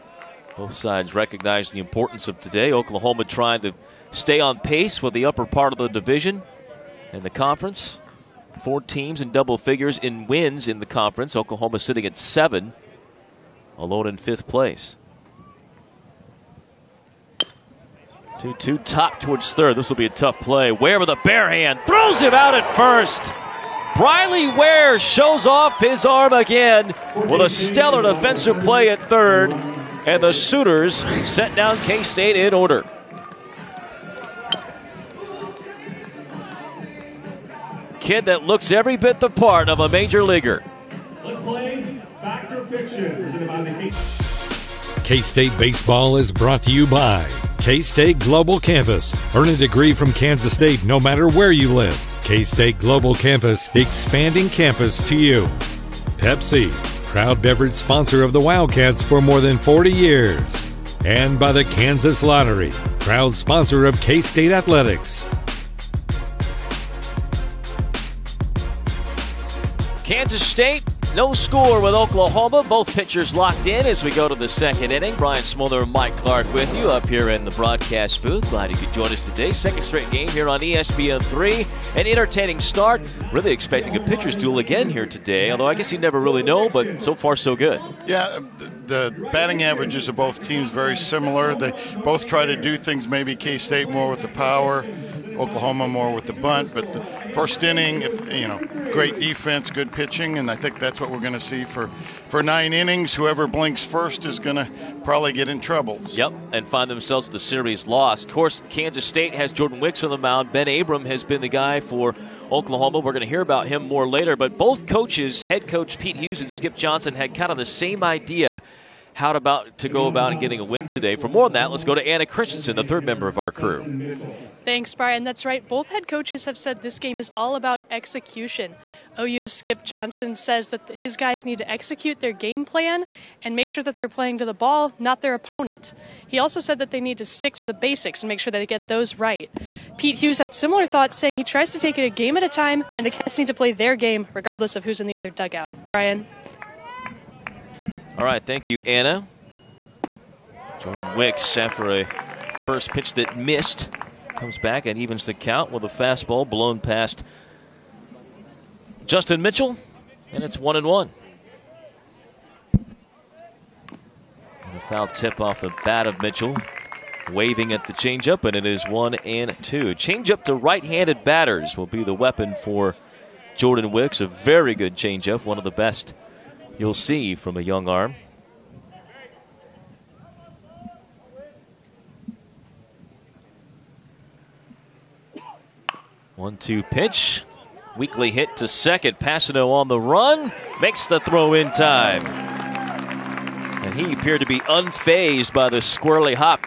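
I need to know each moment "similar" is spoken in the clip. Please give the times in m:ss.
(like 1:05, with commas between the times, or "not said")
1:30, 2:20.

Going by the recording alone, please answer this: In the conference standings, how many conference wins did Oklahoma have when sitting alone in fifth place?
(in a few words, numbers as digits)
7.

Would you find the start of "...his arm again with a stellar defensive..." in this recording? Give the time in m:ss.
0:25.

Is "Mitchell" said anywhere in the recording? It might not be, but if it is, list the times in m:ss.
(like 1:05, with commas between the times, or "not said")
2:39, 2:46.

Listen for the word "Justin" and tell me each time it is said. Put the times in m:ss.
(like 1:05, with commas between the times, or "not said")
2:39.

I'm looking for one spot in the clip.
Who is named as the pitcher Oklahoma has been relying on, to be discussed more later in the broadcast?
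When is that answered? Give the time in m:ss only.
1:50.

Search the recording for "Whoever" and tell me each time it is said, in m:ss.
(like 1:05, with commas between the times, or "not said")
1:43.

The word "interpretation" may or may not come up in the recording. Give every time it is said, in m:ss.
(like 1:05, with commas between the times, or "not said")
not said.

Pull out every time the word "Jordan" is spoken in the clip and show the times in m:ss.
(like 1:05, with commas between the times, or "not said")
1:49, 2:30, 2:53.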